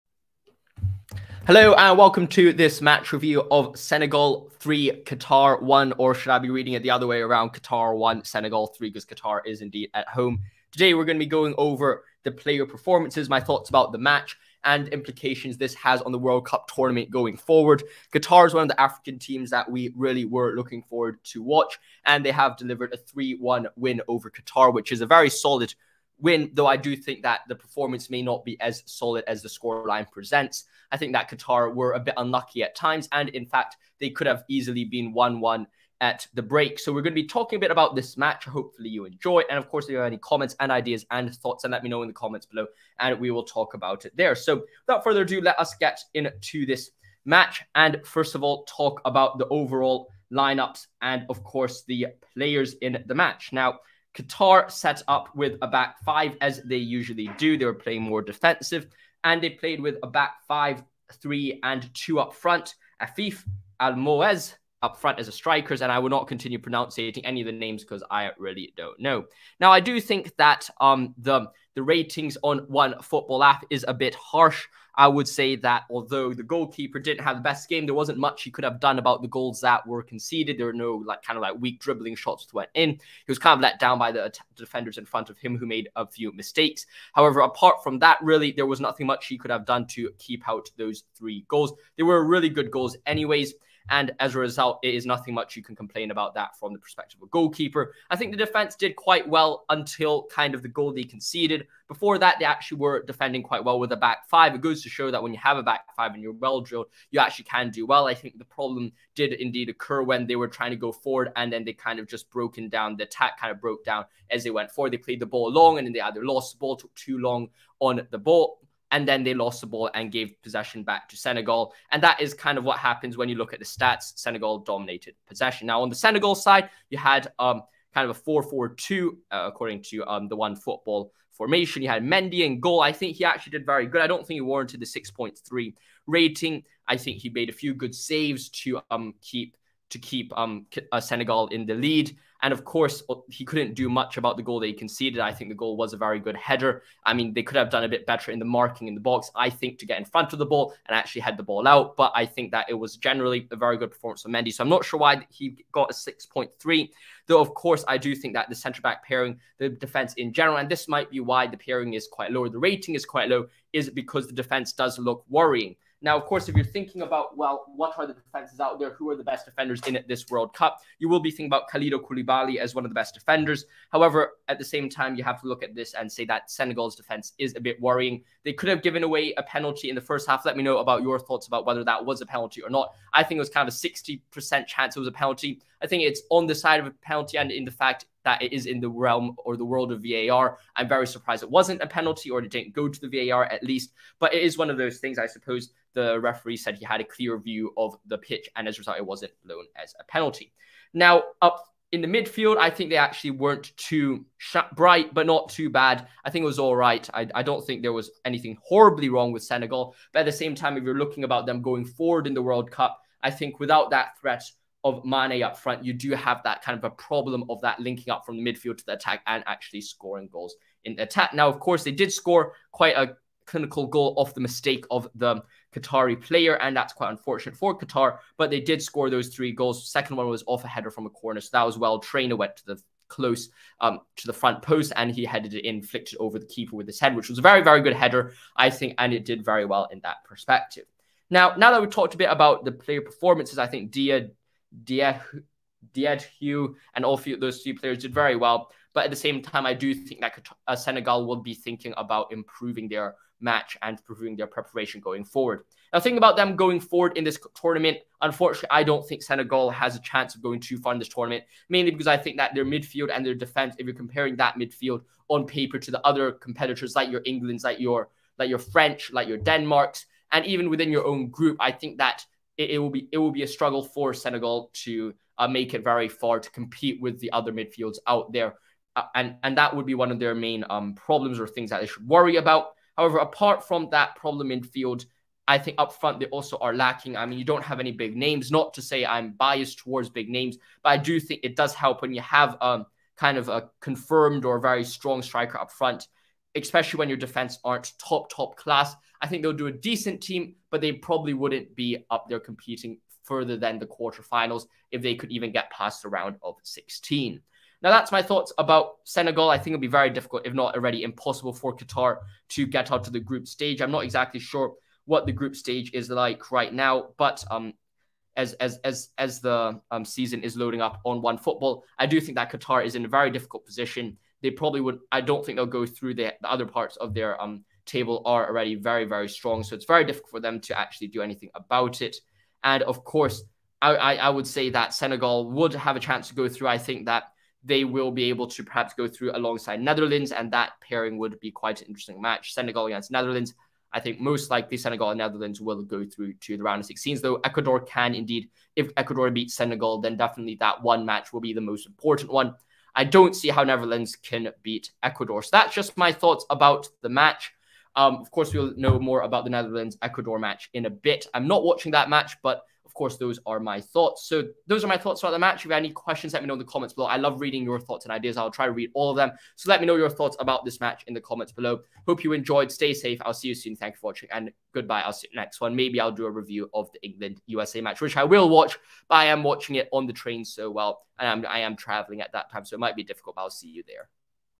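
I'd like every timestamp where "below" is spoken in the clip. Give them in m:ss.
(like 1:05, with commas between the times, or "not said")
0:42, 6:06, 6:11.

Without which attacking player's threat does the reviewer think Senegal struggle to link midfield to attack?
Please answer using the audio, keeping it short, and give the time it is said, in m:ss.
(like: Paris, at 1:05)
Mane, at 3:35.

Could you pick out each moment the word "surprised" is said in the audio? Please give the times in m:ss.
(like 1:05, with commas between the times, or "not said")
3:11.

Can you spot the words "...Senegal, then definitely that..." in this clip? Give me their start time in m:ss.
5:49.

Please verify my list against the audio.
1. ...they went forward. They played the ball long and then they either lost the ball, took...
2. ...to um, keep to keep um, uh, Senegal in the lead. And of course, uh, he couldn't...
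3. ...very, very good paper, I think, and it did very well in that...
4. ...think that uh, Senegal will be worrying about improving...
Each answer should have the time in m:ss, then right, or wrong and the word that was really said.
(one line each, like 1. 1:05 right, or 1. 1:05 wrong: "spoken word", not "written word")
1. 1:54 right
2. 2:18 right
3. 3:57 wrong: "header", not "paper"
4. 4:09 wrong: "thinking", not "worrying".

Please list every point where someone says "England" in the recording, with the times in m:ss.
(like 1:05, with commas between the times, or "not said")
4:27, 6:17.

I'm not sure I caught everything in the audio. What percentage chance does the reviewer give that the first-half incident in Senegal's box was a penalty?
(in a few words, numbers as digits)
60%.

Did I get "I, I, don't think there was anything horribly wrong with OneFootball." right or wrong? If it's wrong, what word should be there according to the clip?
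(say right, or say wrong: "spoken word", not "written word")
wrong: "Senegal", not "OneFootball".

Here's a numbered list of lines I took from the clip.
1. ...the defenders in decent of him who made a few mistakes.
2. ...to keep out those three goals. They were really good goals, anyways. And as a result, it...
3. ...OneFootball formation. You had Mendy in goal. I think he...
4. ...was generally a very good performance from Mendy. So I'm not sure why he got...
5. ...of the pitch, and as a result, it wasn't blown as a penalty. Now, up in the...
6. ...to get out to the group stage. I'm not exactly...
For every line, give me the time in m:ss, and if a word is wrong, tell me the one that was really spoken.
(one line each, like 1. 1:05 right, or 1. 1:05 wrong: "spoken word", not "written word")
1. 1:24 wrong: "front", not "decent"
2. 1:29 right
3. 2:10 right
4. 2:32 right
5. 3:17 right
6. 5:12 right.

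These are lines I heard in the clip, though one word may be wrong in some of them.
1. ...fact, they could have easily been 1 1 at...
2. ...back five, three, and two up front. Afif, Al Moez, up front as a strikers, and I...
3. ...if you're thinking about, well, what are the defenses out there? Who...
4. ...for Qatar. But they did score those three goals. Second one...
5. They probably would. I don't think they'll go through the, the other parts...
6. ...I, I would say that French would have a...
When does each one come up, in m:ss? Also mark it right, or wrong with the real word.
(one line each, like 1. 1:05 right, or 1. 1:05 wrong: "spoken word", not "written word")
1. 0:33 right
2. 1:00 right
3. 2:46 right
4. 3:47 right
5. 5:24 right
6. 5:33 wrong: "Senegal", not "French".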